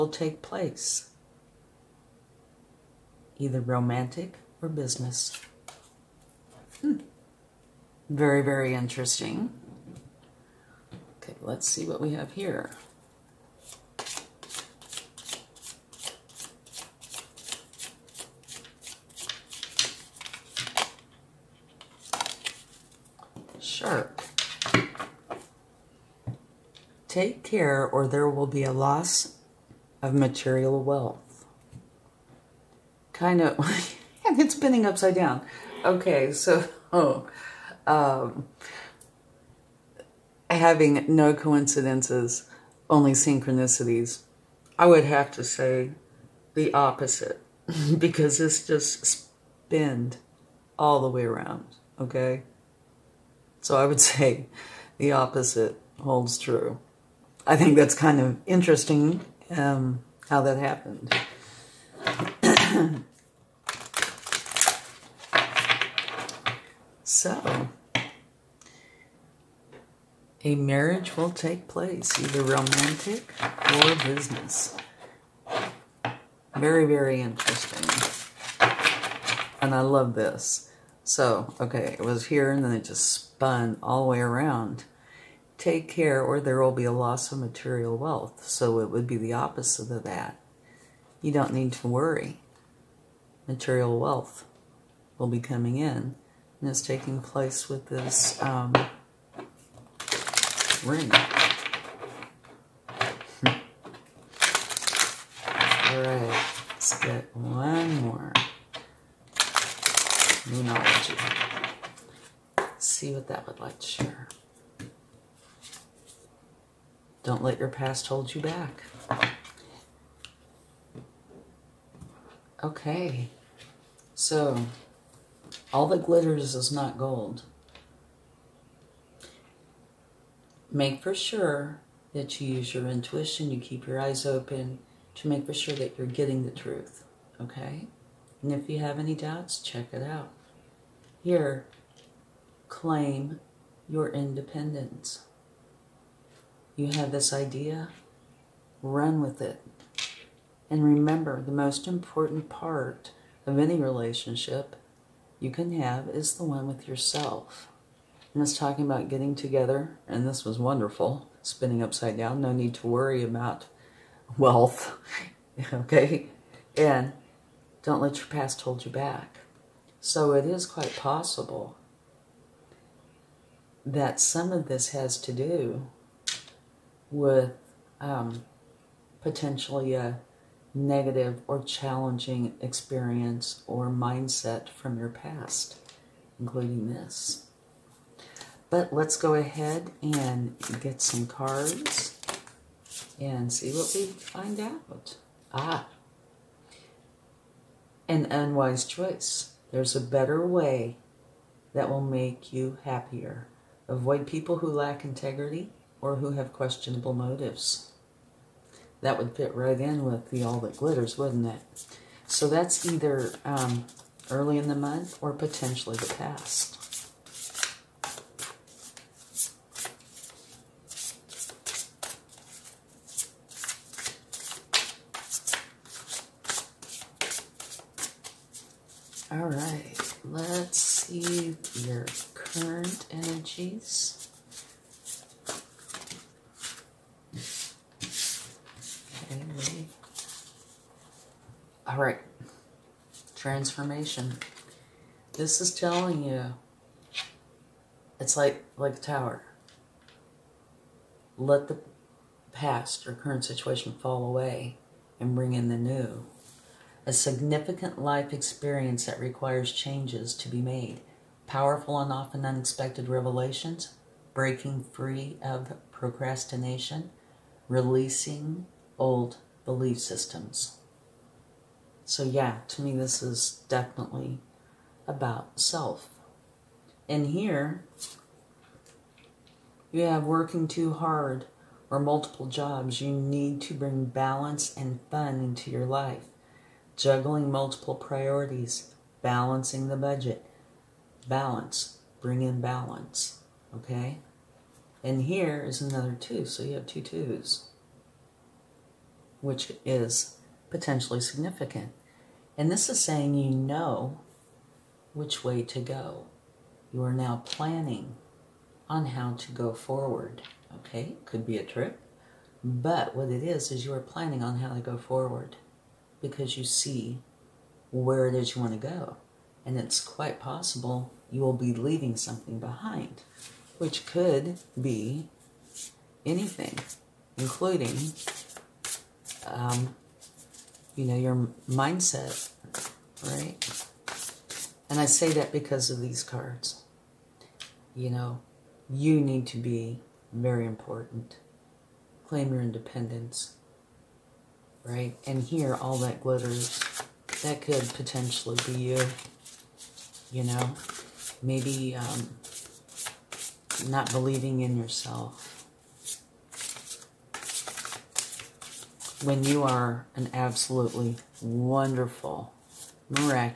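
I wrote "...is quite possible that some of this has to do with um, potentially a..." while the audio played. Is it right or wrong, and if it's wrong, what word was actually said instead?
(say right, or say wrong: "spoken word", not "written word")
right.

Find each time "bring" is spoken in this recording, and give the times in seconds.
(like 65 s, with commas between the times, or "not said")
255 s, 283 s, 292 s.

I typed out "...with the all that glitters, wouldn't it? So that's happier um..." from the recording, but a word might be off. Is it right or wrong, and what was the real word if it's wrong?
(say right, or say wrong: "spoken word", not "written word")
wrong: "either", not "happier".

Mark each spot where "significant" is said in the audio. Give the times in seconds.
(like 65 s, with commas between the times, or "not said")
257 s, 301 s.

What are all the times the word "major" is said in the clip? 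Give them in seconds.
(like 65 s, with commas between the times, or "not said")
not said.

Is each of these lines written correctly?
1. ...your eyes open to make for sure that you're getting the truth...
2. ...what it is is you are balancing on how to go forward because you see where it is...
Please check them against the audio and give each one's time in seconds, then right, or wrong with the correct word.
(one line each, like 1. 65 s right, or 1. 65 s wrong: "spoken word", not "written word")
1. 133 s right
2. 313 s wrong: "planning", not "balancing".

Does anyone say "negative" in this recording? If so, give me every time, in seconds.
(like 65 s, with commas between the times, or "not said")
180 s.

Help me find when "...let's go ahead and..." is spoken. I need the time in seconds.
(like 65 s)
188 s.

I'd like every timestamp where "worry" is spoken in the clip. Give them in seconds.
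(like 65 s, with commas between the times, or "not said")
91 s, 162 s.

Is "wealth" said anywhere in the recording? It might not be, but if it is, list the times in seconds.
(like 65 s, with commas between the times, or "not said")
30 s, 87 s, 93 s, 164 s.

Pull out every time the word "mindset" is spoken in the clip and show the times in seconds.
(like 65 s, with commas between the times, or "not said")
183 s, 331 s.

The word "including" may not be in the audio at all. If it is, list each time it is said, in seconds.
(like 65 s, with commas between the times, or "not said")
186 s, 327 s.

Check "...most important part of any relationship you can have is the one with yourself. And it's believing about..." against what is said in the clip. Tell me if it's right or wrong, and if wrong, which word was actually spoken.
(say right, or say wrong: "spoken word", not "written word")
wrong: "talking", not "believing".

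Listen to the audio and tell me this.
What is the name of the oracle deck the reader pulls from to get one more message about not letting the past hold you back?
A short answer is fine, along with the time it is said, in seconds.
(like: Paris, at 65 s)
Moonology, at 110 s.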